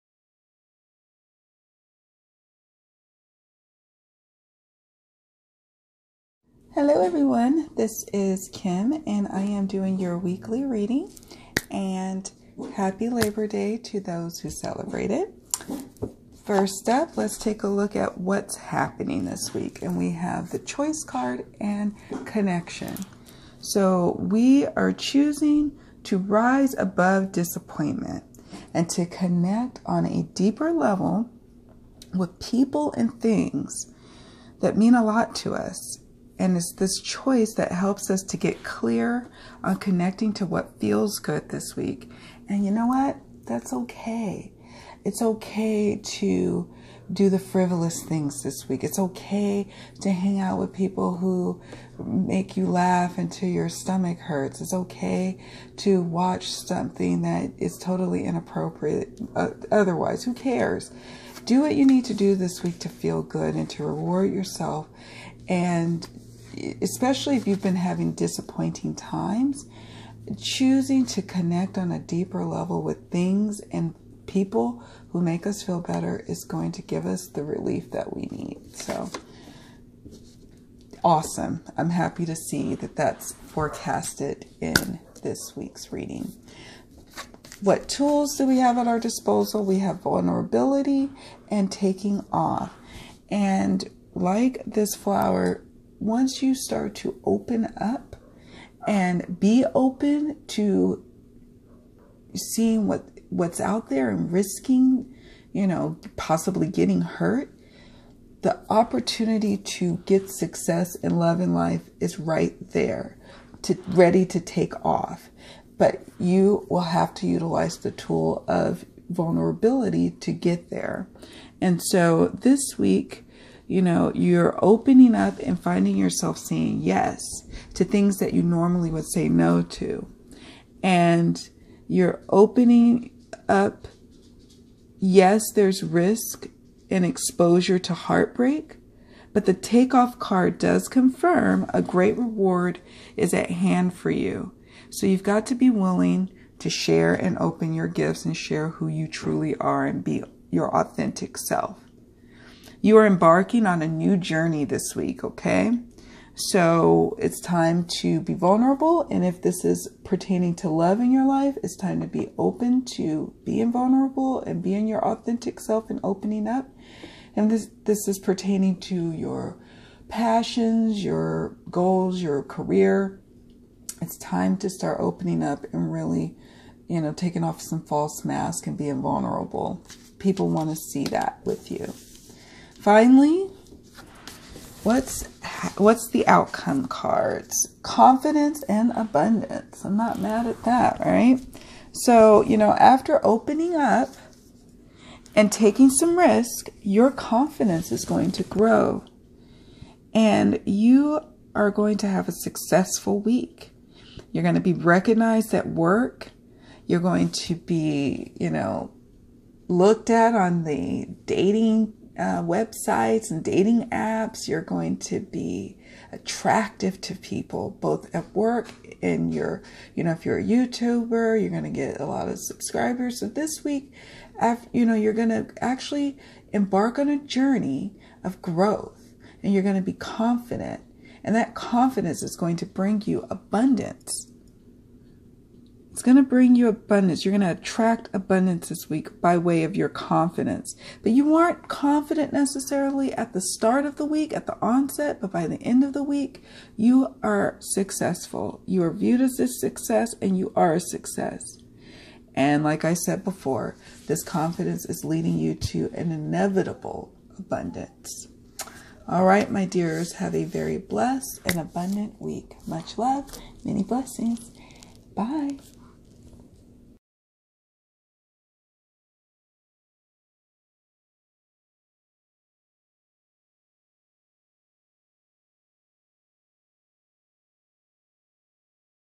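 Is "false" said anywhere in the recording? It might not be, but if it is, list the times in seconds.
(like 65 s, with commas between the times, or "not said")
177 s.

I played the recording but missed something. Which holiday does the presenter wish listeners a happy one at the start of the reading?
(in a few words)
Labor Day.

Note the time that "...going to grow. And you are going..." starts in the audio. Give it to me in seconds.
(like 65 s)
198 s.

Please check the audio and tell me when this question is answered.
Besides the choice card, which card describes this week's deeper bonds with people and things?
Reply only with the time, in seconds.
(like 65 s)
22 s.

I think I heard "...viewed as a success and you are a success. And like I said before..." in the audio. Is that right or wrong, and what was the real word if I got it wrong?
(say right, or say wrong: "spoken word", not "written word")
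right.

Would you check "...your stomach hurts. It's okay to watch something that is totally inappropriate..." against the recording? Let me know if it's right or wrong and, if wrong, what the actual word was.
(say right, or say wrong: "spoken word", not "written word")
right.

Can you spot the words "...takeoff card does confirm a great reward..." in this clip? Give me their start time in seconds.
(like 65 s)
139 s.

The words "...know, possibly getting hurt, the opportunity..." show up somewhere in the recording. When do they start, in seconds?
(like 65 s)
105 s.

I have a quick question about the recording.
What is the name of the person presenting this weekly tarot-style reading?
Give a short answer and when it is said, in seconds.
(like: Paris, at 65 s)
Kim, at 8 s.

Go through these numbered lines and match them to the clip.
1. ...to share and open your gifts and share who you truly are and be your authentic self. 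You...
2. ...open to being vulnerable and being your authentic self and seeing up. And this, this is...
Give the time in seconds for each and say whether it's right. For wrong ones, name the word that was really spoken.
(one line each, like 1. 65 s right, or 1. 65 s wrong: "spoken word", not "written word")
1. 146 s right
2. 162 s wrong: "opening", not "seeing".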